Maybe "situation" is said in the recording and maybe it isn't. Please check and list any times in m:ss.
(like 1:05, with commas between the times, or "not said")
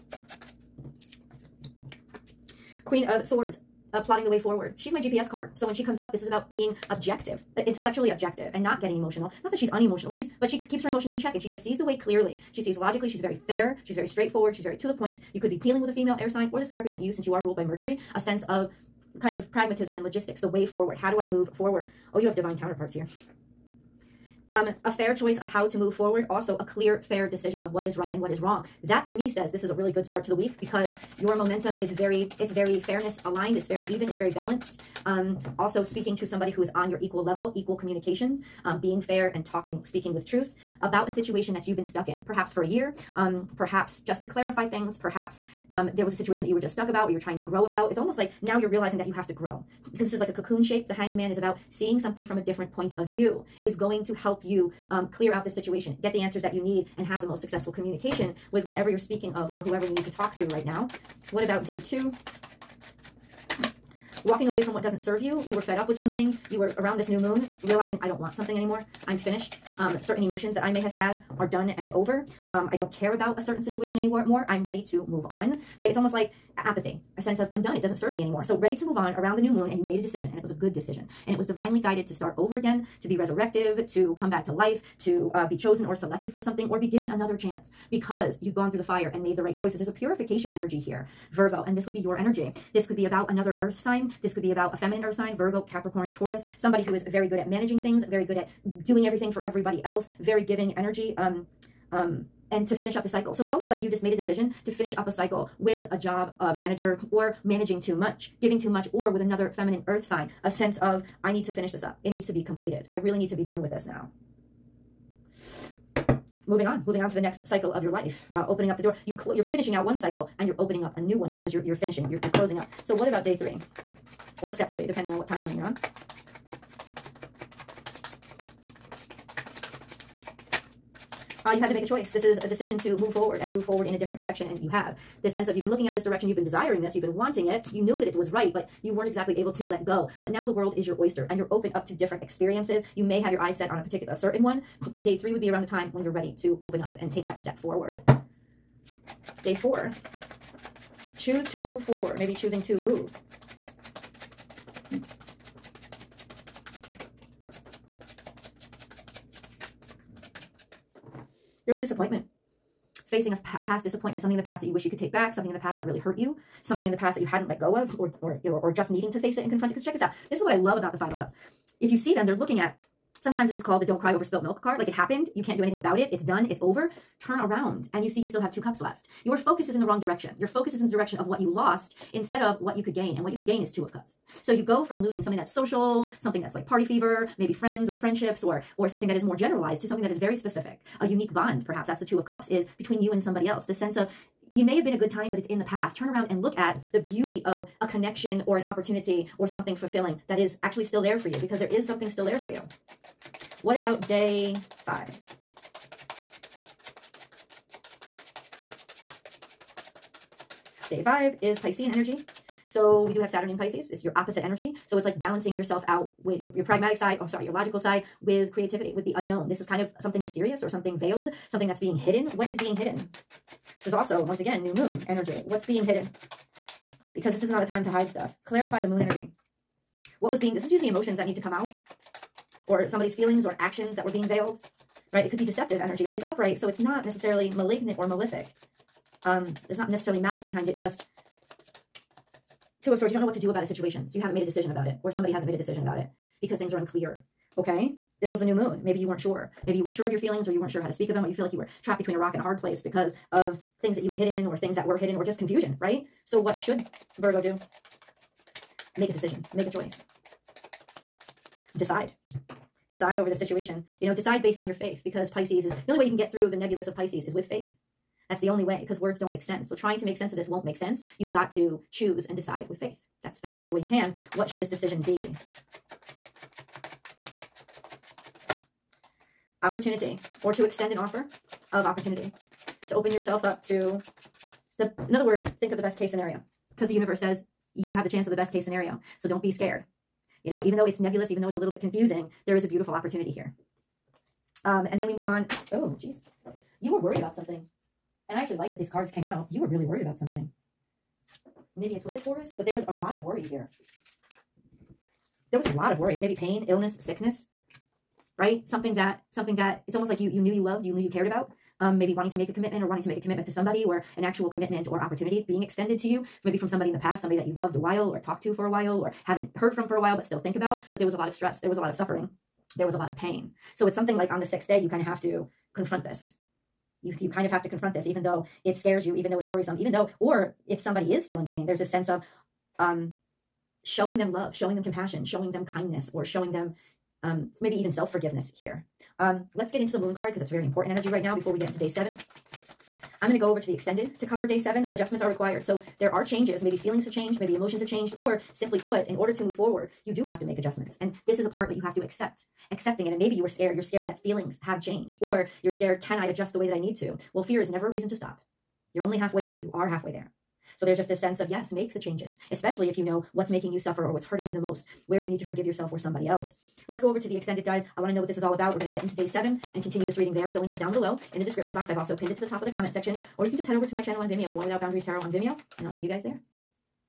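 0:41, 0:46, 0:55, 1:13, 4:03, 4:23.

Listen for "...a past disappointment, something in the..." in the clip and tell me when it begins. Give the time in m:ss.
2:43.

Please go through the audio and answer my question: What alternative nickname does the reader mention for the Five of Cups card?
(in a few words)
Don't cry over spilt milk card.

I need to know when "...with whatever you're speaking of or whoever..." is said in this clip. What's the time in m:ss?
0:58.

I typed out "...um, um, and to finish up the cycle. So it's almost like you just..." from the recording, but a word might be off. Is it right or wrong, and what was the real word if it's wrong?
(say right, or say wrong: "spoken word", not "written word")
right.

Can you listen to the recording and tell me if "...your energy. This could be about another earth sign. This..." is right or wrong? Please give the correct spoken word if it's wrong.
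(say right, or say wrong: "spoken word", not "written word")
right.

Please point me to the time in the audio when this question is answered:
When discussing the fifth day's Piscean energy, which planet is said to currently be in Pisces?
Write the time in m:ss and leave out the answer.
3:33.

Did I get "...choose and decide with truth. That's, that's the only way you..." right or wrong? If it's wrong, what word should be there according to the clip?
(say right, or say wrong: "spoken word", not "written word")
wrong: "faith", not "truth".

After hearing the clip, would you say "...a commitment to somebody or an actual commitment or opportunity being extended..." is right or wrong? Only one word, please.
right.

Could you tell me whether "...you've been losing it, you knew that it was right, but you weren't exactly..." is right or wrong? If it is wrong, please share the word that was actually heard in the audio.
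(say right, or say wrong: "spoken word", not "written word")
wrong: "wanting", not "losing".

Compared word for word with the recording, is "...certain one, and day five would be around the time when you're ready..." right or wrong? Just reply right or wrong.
wrong.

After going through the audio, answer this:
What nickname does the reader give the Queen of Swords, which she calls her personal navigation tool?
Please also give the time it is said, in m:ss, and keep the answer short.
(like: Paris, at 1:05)
GPS card, at 0:05.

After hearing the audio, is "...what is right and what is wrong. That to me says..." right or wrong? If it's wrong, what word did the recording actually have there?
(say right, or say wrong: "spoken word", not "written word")
right.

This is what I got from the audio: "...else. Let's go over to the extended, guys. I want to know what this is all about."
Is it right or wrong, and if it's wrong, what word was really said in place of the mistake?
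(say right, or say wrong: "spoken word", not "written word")
right.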